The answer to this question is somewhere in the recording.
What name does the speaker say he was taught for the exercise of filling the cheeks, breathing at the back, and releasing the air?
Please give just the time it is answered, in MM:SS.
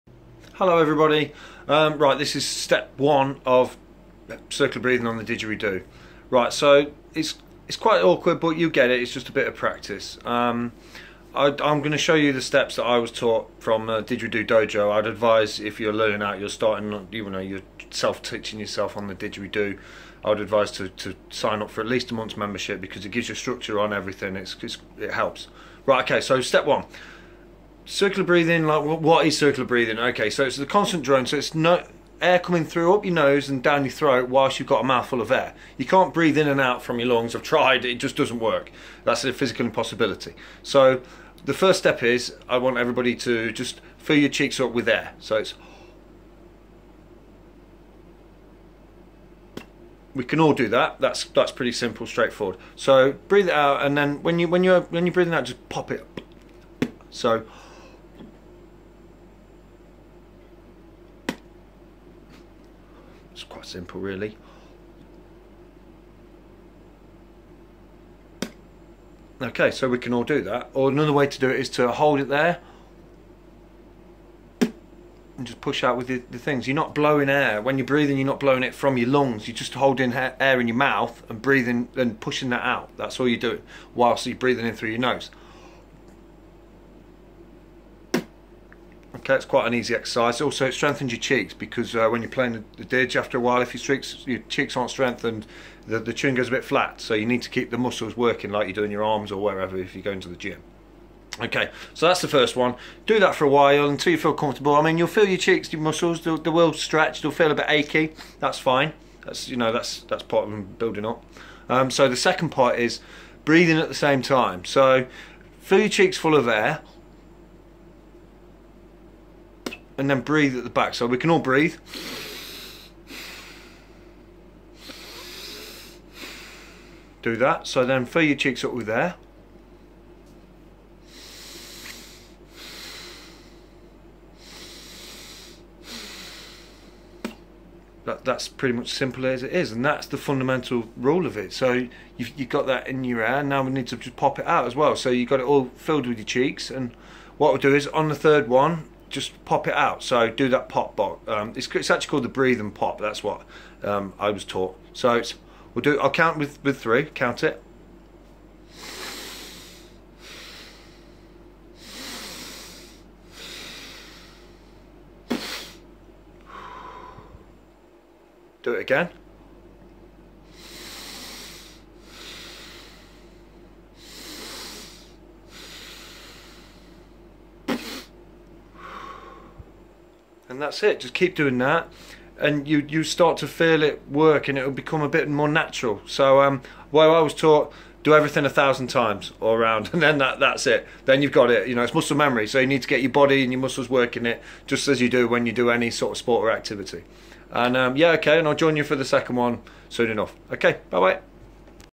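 02:32.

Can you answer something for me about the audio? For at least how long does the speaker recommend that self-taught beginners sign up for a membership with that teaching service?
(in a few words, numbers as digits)
a month.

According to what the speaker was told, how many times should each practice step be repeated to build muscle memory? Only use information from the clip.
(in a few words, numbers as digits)
1000.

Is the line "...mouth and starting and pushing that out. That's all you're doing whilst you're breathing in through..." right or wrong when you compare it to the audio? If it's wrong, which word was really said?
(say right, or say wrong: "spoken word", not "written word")
wrong: "breathing", not "starting".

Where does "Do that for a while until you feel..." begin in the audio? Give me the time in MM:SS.
01:43.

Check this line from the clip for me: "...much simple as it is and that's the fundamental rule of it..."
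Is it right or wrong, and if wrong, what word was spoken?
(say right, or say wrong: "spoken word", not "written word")
right.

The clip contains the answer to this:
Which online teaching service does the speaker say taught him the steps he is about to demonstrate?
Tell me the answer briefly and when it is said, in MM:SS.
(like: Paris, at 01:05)
Didgeridoo Dojo, at 00:14.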